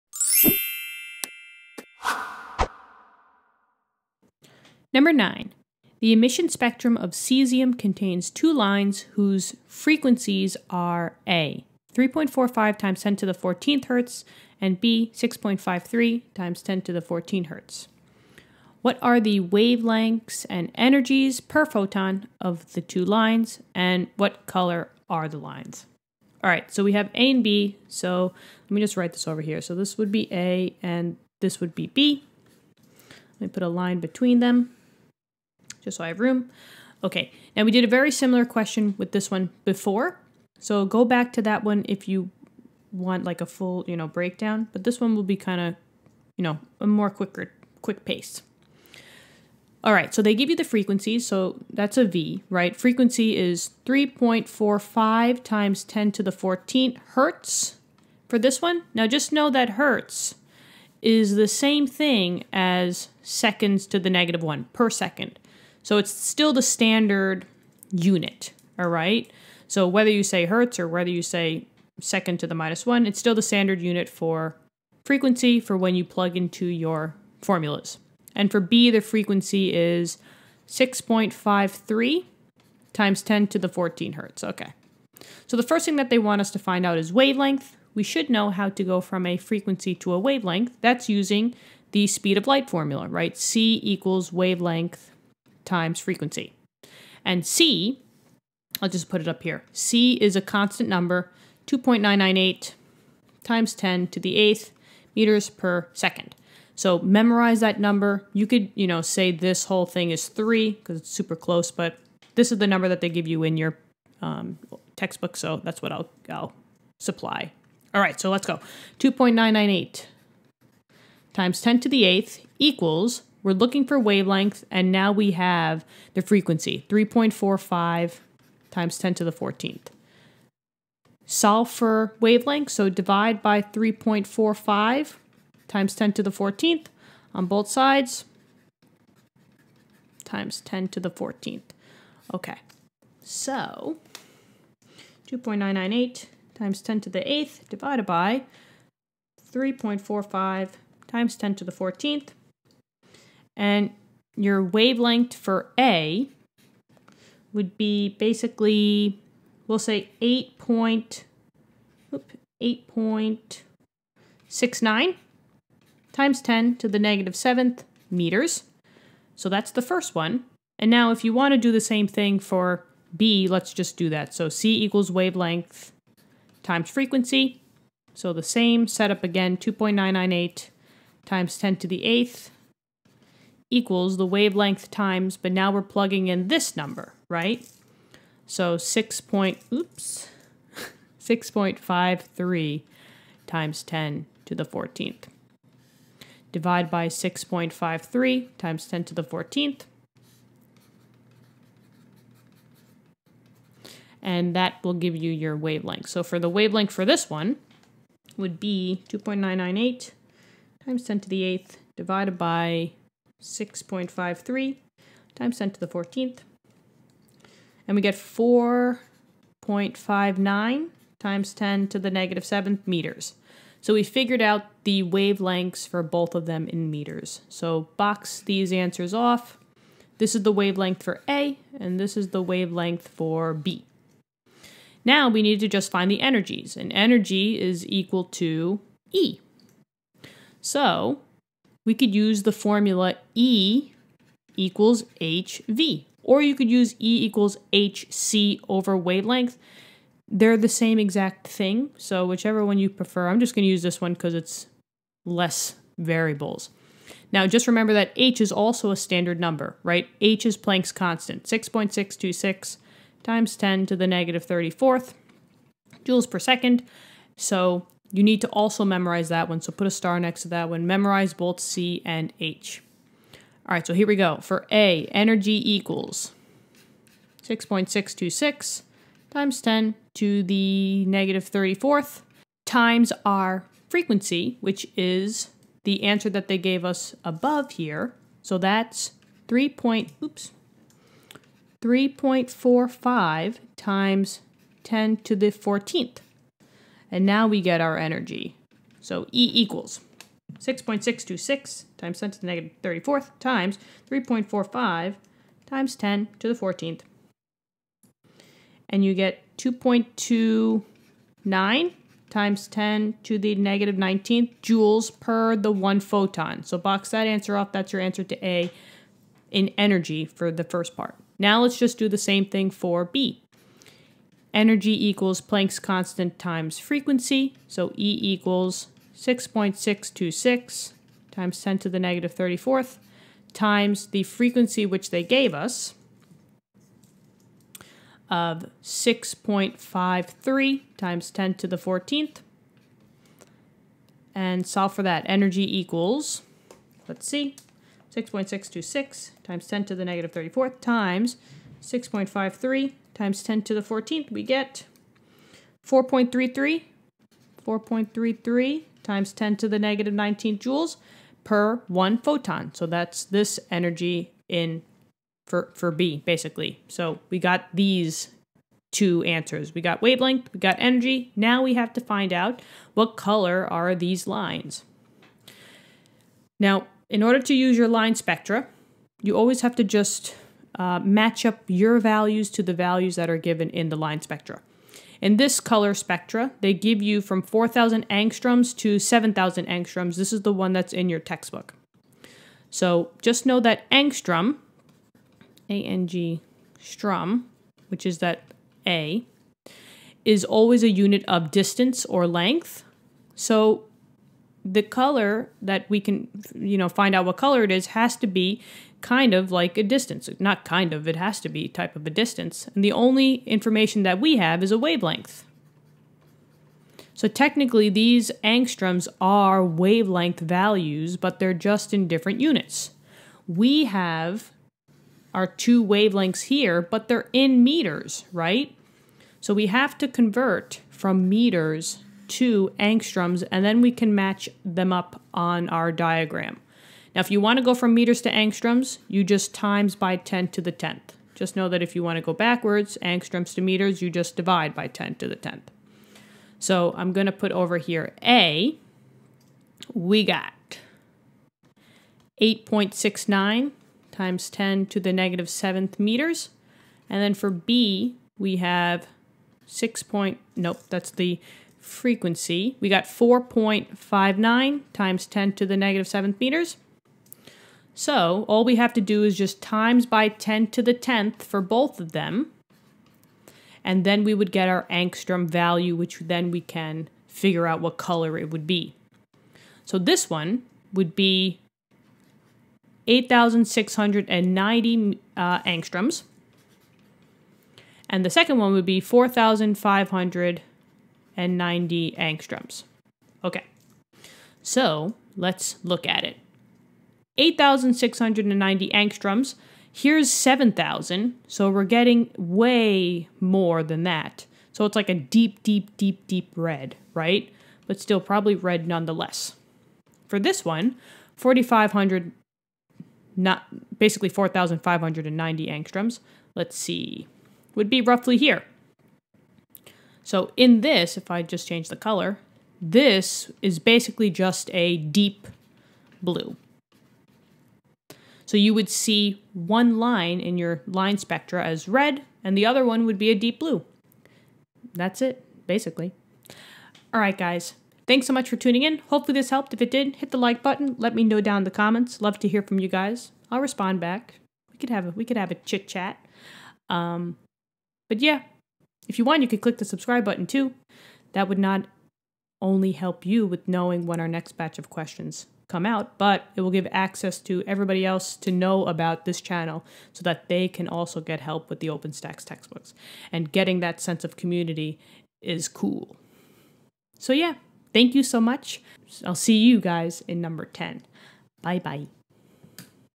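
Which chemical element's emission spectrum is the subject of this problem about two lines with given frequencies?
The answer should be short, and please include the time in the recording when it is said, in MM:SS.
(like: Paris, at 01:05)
cesium, at 00:07.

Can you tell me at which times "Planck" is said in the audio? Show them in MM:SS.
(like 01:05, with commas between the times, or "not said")
04:20, 05:25.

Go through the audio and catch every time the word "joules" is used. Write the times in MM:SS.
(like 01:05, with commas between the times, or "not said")
04:26, 05:14, 06:00.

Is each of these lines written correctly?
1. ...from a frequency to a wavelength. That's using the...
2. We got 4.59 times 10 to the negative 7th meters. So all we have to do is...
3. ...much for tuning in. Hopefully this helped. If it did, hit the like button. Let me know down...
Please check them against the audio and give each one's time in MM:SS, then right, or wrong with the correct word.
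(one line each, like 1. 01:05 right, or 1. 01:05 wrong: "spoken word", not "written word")
1. 01:29 right
2. 07:42 right
3. 08:58 right.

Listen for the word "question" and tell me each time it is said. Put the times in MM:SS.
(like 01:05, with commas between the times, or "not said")
00:38, 09:14.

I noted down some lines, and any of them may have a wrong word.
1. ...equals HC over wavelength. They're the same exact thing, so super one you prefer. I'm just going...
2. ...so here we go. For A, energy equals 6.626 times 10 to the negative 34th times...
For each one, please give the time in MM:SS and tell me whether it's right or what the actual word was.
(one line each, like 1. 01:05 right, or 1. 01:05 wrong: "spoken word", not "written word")
1. 04:07 wrong: "whichever", not "super"
2. 04:33 right.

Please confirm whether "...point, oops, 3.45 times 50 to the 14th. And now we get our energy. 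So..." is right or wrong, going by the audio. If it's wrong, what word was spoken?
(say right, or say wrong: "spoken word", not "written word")
wrong: "10", not "50".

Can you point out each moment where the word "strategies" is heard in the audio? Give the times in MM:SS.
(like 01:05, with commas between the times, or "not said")
not said.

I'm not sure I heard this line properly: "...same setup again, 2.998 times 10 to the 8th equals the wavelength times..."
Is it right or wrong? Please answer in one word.
right.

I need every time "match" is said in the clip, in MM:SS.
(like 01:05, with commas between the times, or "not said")
06:20, 07:14.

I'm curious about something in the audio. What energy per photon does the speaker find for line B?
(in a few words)
4.33 x 10^-19 J.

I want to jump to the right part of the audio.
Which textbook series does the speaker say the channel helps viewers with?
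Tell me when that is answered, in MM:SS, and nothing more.
09:21.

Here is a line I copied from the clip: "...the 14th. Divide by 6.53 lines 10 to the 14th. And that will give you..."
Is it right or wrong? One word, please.
wrong.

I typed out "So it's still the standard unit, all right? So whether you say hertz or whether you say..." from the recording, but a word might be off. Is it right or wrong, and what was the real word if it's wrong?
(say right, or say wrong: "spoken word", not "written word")
right.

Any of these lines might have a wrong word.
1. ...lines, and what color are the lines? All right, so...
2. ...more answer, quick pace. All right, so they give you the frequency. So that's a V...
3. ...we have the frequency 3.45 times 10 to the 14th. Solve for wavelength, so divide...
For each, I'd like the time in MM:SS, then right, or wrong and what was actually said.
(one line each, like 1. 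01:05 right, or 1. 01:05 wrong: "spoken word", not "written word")
1. 00:23 right
2. 00:46 wrong: "quicker", not "answer"
3. 02:05 right.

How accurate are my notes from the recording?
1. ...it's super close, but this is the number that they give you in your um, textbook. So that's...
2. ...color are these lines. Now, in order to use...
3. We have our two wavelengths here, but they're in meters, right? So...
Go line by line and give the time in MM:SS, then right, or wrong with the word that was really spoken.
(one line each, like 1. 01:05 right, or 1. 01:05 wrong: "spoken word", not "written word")
1. 01:50 right
2. 06:13 right
3. 07:03 right.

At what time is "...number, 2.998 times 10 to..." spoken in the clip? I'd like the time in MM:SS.
01:40.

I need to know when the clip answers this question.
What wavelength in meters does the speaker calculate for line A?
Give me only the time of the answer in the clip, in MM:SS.
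02:40.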